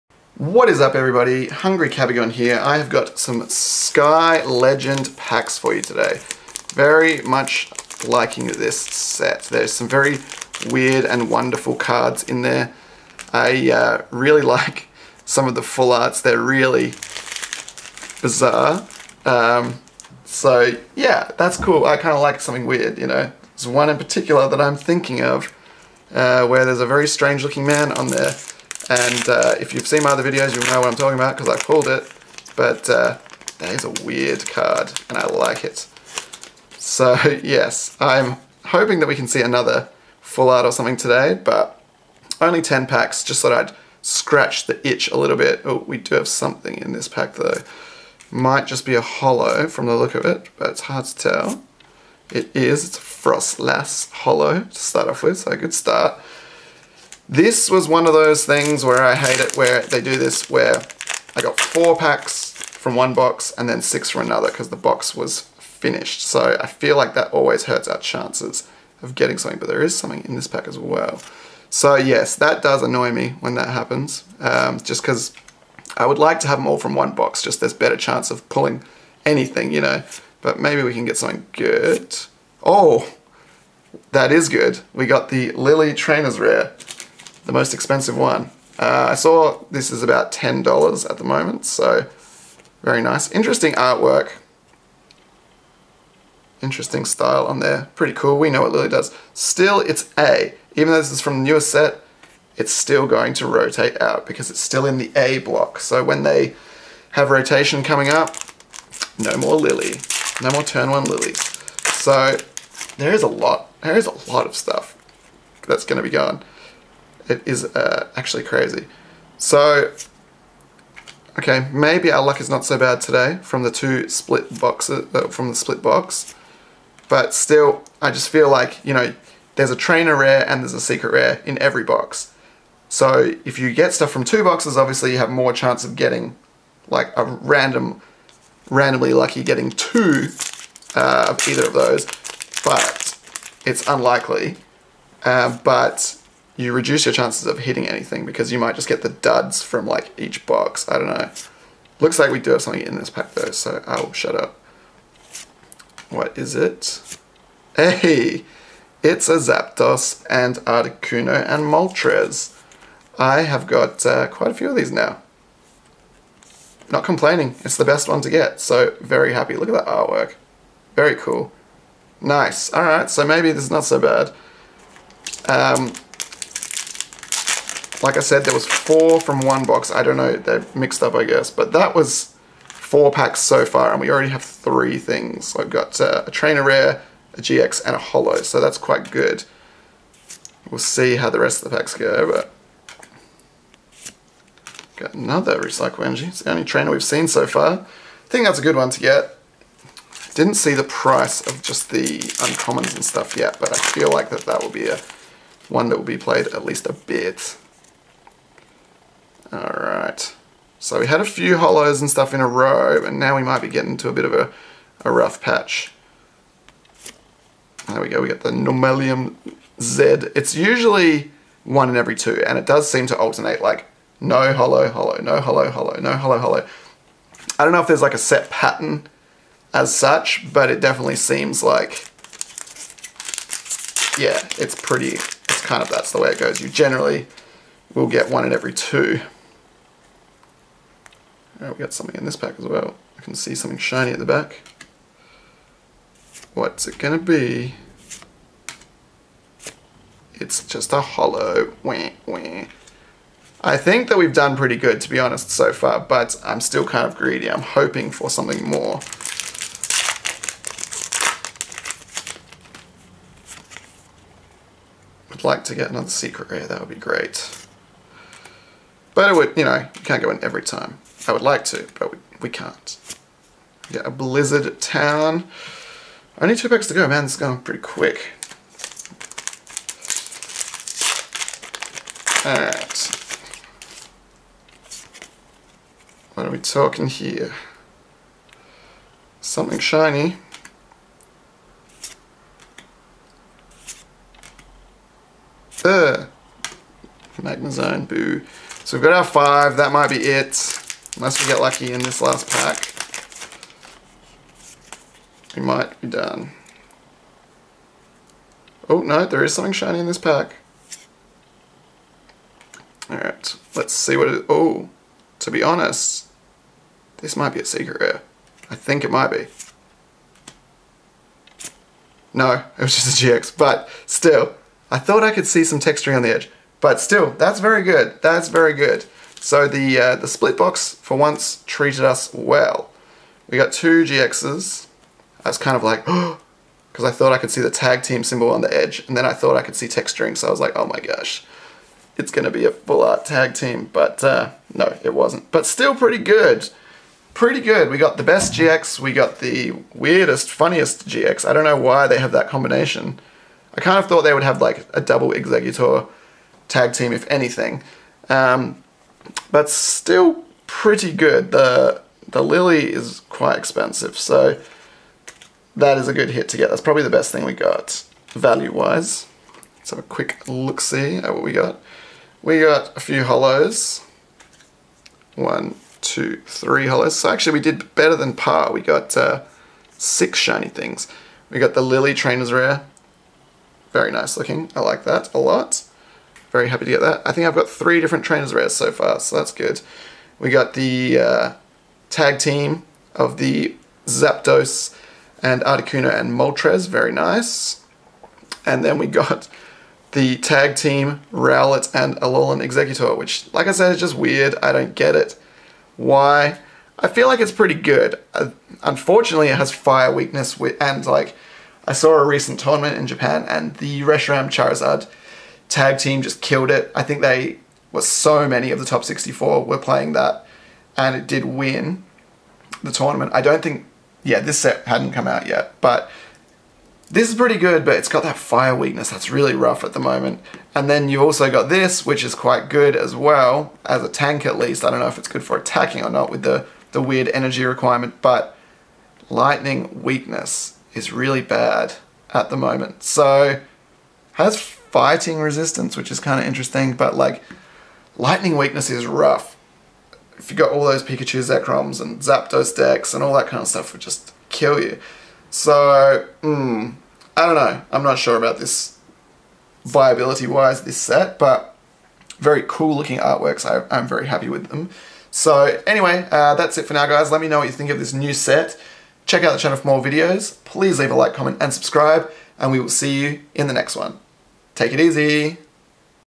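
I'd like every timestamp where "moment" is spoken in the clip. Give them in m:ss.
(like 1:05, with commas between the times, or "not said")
1:31, 7:10, 7:22.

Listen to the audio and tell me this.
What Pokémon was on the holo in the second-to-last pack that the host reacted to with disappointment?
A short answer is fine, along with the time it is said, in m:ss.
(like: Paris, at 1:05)
Magnazone, at 4:57.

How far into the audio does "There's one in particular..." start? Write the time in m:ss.
0:23.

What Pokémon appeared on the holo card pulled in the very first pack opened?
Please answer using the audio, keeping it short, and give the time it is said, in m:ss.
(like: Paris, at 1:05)
Froslass, at 0:53.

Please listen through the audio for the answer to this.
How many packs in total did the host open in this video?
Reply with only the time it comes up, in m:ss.
0:42.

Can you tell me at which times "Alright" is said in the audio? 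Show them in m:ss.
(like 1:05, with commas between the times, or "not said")
2:52, 4:42, 5:13.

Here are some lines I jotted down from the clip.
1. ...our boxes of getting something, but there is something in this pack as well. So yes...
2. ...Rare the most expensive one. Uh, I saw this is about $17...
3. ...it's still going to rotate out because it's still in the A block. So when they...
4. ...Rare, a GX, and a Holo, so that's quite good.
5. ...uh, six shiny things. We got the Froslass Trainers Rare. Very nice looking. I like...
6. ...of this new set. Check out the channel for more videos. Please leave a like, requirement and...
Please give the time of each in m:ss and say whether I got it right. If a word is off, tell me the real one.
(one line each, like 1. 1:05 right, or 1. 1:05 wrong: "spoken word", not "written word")
1. 1:07 wrong: "chances", not "boxes"
2. 1:26 wrong: "10", not "17"
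3. 1:42 right
4. 3:06 right
5. 6:19 wrong: "Lillie", not "Froslass"
6. 7:47 wrong: "comment", not "requirement".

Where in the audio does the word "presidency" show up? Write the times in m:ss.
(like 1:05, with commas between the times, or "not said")
not said.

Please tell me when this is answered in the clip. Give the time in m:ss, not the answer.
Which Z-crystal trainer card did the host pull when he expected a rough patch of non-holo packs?
3:38.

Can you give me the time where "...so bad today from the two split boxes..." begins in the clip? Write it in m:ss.
2:02.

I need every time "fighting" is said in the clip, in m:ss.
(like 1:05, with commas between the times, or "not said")
7:24.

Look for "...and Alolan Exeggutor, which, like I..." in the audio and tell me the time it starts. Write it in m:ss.
6:41.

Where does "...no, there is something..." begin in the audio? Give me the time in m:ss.
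5:09.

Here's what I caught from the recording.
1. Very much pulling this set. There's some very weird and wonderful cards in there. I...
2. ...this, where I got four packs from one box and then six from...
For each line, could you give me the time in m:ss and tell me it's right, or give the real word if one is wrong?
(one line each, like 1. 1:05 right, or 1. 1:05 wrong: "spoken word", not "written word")
1. 0:06 wrong: "liking", not "pulling"
2. 1:00 right.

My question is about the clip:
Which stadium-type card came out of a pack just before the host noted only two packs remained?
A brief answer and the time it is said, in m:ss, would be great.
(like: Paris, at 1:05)
Blizzard Town, at 4:34.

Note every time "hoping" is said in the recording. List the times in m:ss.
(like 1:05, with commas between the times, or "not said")
0:38, 4:17.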